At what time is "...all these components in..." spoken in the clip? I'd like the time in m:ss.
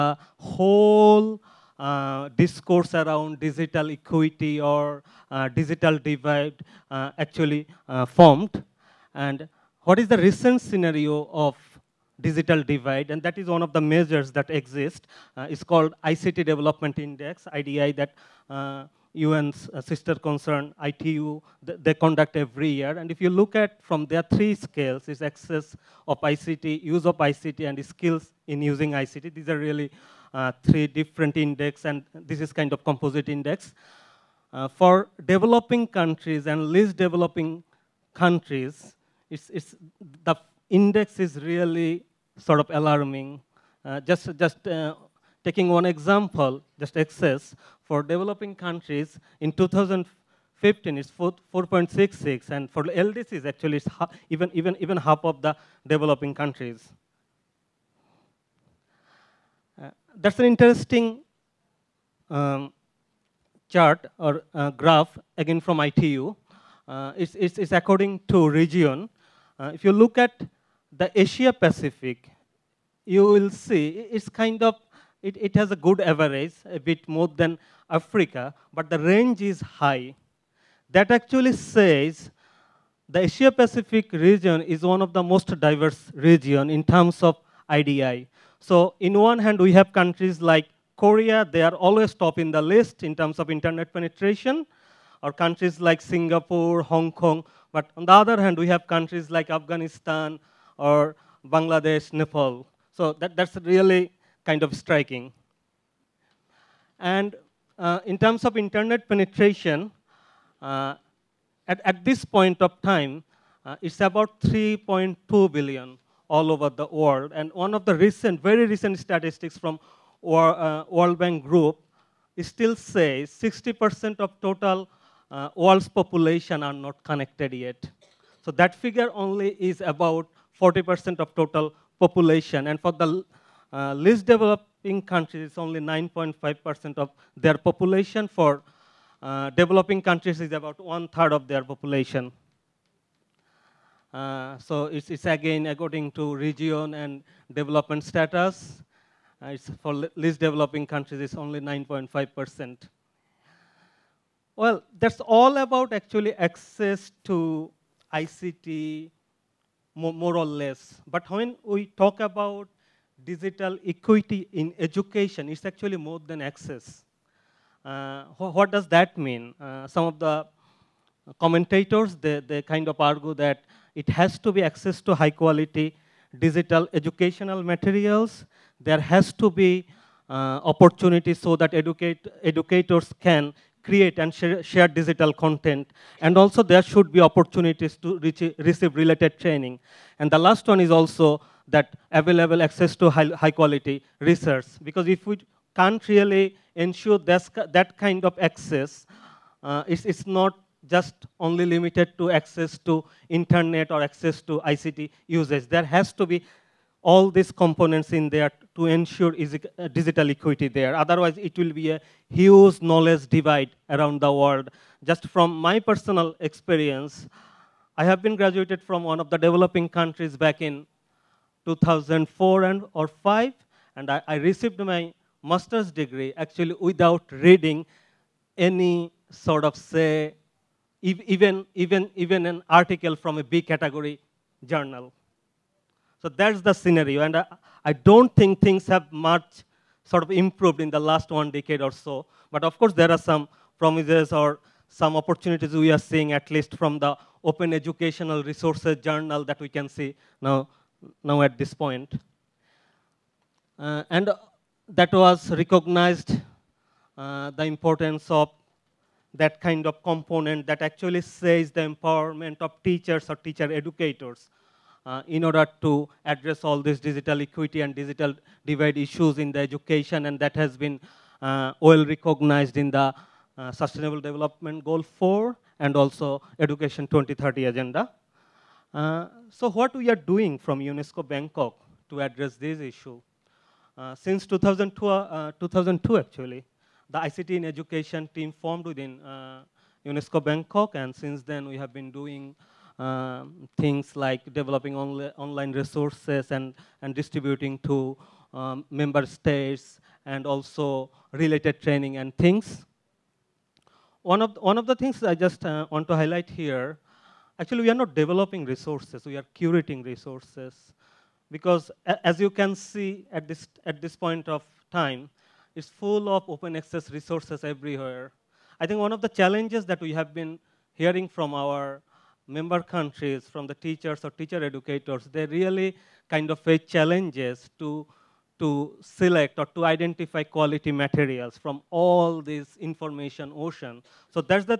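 3:27.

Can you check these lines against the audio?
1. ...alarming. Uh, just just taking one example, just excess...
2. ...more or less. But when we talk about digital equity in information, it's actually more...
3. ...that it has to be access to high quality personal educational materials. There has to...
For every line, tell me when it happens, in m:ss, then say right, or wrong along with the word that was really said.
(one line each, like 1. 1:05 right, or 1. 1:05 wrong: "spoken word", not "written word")
1. 0:42 right
2. 2:40 wrong: "education", not "information"
3. 2:53 wrong: "digital", not "personal".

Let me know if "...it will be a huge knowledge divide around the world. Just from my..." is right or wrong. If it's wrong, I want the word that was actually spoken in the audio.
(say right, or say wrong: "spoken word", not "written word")
right.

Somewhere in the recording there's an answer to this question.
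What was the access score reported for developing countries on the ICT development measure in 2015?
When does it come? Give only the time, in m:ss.
0:51.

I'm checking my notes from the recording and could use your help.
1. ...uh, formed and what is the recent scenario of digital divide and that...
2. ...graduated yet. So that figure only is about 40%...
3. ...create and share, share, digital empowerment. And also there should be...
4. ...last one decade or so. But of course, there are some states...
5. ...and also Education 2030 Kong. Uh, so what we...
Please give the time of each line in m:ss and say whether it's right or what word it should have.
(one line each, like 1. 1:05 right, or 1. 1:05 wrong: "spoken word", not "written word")
1. 0:07 right
2. 2:07 wrong: "connected", not "graduated"
3. 3:03 wrong: "content", not "empowerment"
4. 4:00 wrong: "promises", not "states"
5. 4:35 wrong: "Agenda", not "Kong".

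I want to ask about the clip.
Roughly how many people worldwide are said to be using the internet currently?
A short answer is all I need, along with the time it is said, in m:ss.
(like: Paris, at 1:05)
3.2 billion, at 1:54.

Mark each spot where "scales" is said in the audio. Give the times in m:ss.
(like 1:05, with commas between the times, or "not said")
0:24.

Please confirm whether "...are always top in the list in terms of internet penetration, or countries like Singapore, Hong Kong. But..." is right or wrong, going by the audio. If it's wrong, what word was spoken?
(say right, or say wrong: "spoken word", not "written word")
right.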